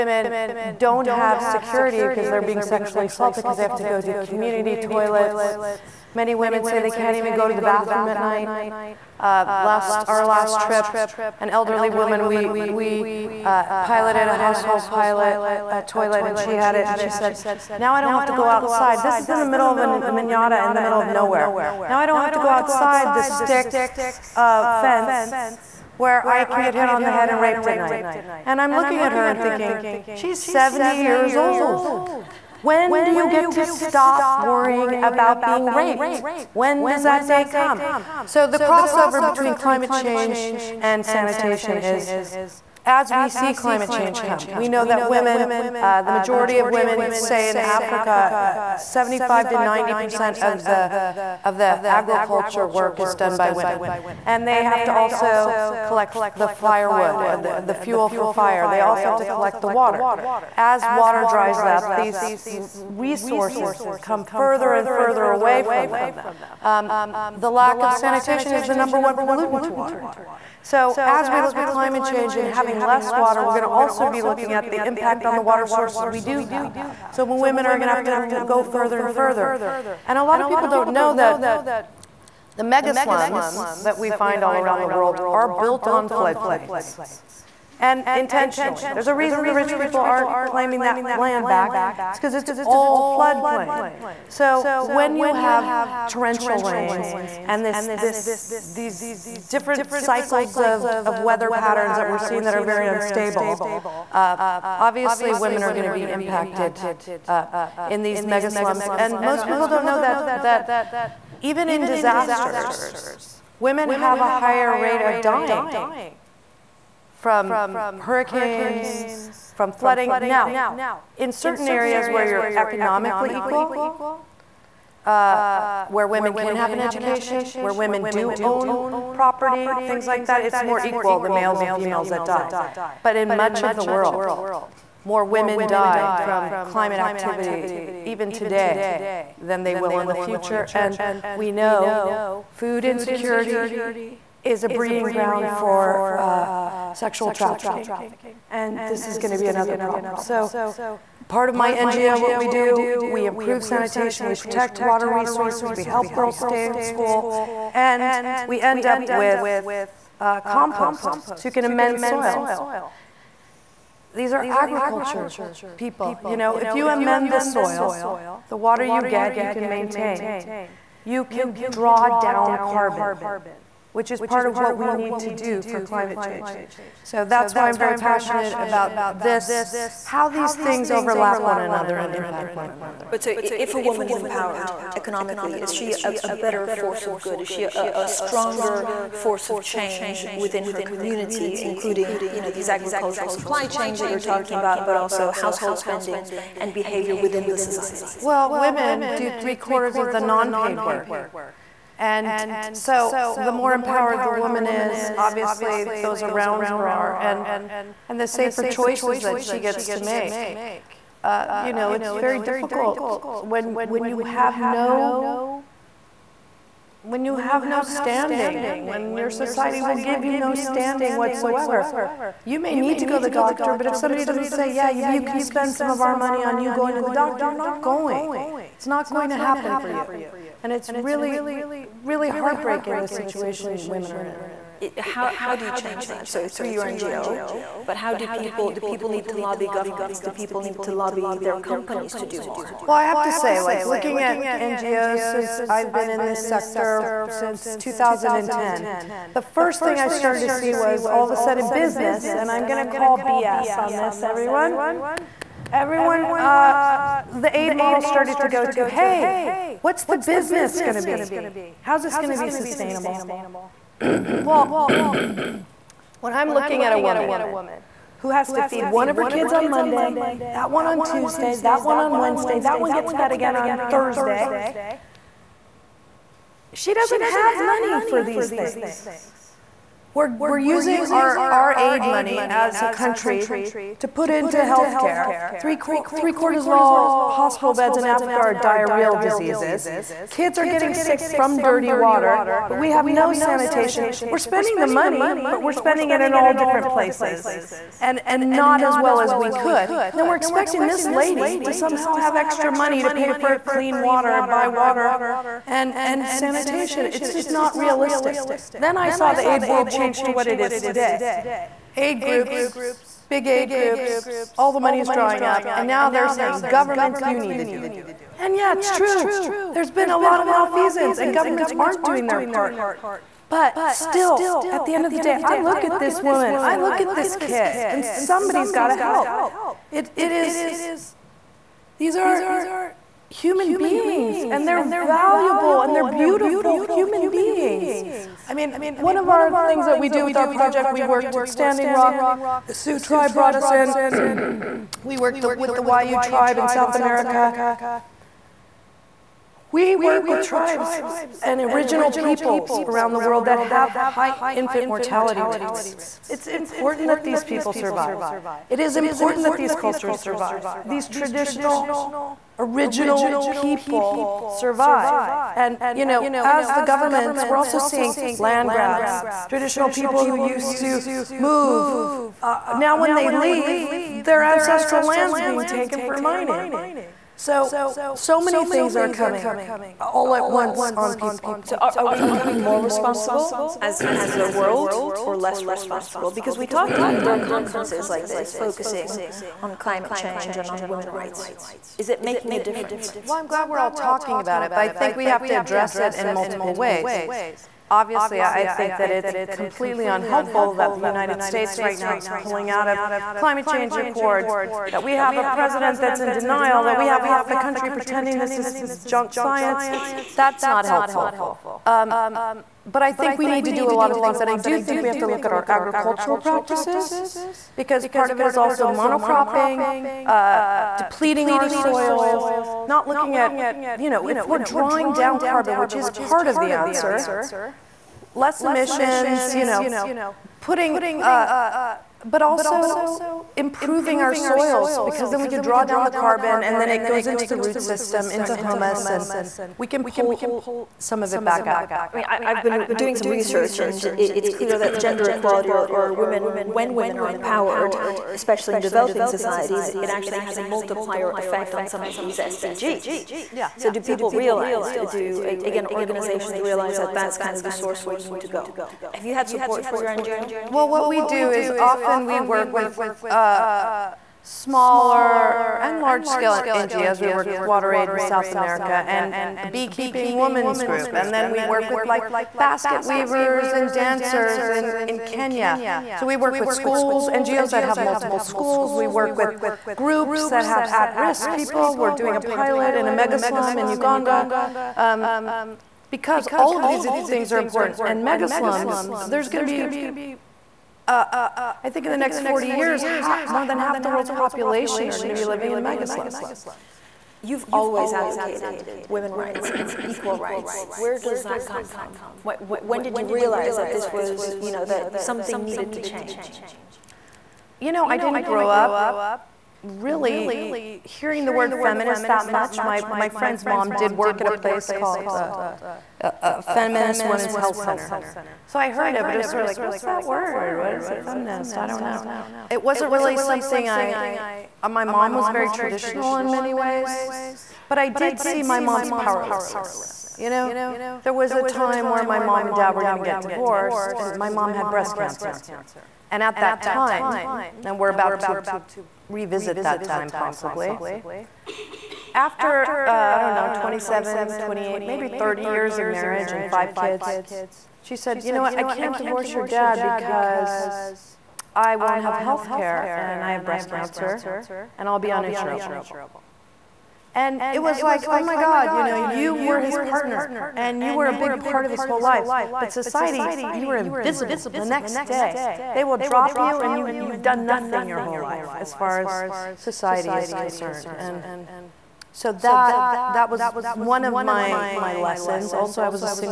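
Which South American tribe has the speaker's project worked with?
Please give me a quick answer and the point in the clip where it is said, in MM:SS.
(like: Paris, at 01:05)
Wayuu, at 05:45.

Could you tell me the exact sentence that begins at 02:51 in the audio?
You can draw down carbon, which is part of what we need to do for climate change.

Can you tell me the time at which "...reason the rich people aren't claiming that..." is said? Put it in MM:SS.
01:29.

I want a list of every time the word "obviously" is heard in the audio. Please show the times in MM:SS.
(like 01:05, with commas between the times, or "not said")
01:44, 03:25, 06:37.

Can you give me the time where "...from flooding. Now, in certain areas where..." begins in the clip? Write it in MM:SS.
01:59.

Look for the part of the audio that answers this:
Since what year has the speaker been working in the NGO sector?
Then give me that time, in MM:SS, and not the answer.
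04:07.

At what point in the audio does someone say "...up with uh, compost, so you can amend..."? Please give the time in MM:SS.
02:38.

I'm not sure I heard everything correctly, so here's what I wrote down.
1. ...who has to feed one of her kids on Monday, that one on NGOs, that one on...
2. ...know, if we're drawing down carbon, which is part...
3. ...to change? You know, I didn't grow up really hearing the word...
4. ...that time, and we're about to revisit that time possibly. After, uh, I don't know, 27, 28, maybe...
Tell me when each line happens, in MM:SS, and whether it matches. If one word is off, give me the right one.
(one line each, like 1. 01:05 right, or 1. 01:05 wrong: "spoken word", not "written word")
1. 04:28 wrong: "Tuesday", not "NGOs"
2. 07:04 right
3. 08:25 right
4. 08:56 right.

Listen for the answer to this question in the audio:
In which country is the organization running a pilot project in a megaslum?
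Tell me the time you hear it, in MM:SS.
08:03.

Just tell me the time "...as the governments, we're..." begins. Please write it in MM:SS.
06:06.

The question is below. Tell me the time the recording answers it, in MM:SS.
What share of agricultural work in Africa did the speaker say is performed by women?
00:48.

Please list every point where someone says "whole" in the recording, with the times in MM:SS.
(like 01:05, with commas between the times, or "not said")
09:22, 09:28.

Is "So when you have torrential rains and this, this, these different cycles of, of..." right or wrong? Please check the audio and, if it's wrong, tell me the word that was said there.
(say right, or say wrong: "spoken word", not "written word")
right.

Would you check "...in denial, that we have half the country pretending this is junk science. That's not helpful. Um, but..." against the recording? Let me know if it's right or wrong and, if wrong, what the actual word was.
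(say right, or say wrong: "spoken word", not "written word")
right.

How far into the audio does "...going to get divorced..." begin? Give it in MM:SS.
08:53.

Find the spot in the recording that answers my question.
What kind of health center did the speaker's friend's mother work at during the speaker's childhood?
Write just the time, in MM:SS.
08:36.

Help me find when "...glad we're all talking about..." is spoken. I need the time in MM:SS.
06:33.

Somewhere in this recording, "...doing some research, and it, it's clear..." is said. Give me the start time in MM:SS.
07:22.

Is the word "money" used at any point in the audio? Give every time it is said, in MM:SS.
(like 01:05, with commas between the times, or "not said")
03:46, 04:37, 04:42, 04:54, 05:02, 05:14.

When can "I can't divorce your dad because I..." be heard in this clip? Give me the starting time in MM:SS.
09:08.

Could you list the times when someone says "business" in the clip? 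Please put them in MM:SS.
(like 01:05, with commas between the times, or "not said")
04:11, 04:20.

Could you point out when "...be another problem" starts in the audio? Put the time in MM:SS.
02:29.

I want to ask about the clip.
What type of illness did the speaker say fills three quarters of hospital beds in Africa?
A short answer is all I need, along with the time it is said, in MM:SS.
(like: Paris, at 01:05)
Diarrheal diseases, at 04:48.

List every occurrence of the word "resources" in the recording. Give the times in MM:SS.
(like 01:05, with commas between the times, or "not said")
01:02, 02:35.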